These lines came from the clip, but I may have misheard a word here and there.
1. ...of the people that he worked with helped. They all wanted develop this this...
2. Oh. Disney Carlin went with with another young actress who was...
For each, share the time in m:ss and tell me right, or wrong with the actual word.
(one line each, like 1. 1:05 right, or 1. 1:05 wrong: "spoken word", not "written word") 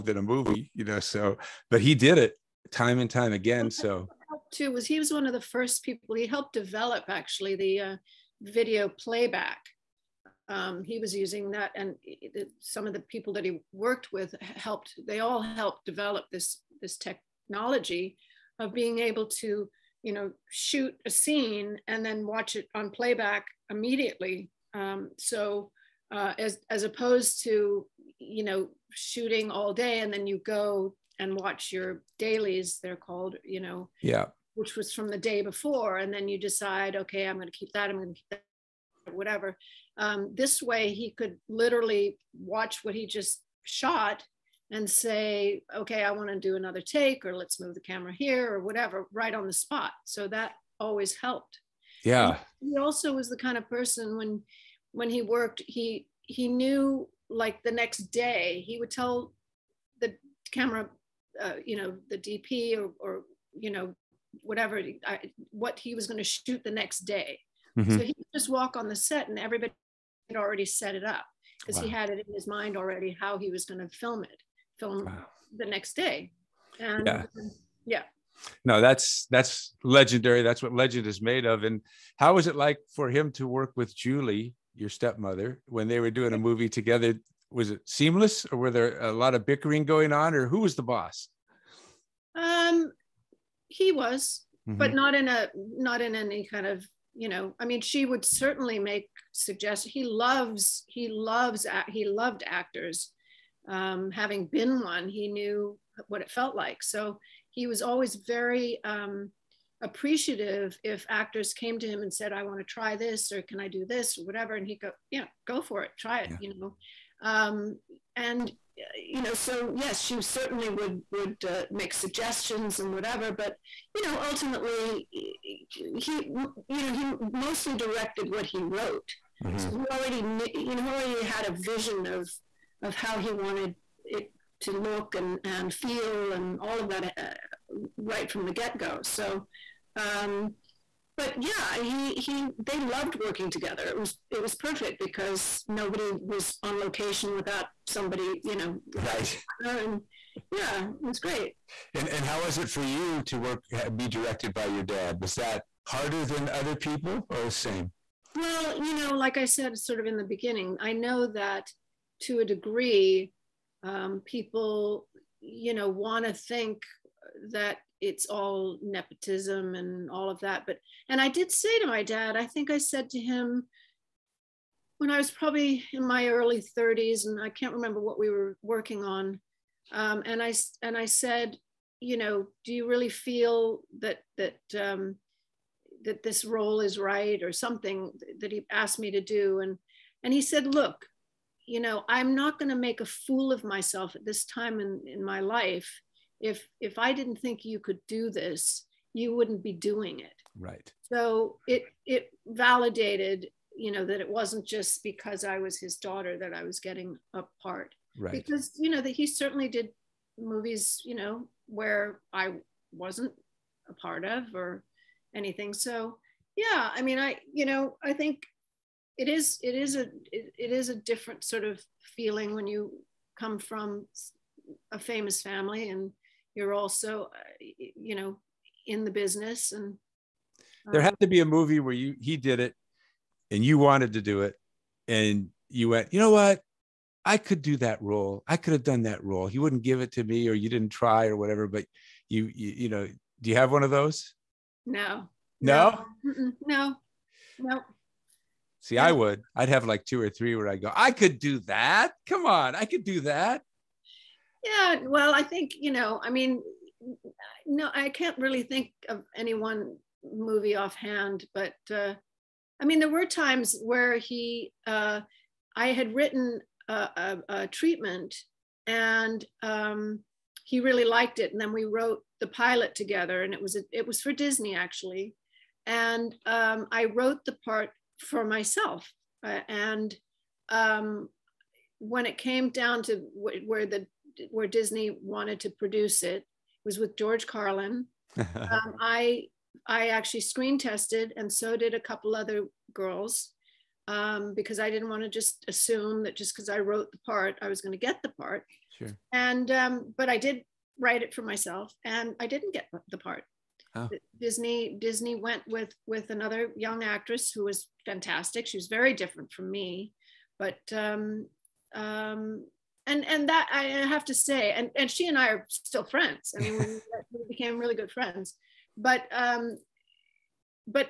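1. 0:12 wrong: "helped", not "wanted"
2. 5:03 wrong: "Disney", not "Carlin".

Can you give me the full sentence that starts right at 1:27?
Was it seamless, or were there a lot of bickering going on, or who was the boss?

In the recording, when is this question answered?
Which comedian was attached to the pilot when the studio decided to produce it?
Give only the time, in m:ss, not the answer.
4:47.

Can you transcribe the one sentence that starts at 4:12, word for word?
Come on, I could do that.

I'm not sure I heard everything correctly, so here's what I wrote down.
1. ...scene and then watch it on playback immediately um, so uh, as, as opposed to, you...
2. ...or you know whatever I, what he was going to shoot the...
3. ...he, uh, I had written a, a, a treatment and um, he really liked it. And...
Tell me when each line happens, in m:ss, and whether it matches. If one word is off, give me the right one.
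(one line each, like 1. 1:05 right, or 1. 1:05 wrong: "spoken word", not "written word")
1. 0:21 right
2. 1:02 right
3. 4:24 right.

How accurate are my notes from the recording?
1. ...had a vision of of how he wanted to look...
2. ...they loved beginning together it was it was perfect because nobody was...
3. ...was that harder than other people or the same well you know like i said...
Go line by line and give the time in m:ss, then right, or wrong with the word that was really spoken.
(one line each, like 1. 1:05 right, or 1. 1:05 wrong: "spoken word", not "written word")
1. 2:11 right
2. 2:22 wrong: "working", not "beginning"
3. 2:35 right.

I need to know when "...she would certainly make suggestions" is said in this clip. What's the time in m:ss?
1:37.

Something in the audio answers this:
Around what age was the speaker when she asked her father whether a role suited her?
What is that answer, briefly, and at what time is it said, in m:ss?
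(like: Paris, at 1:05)
early 30s, at 2:56.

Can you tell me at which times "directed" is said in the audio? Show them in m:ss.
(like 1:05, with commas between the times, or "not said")
2:07, 2:34.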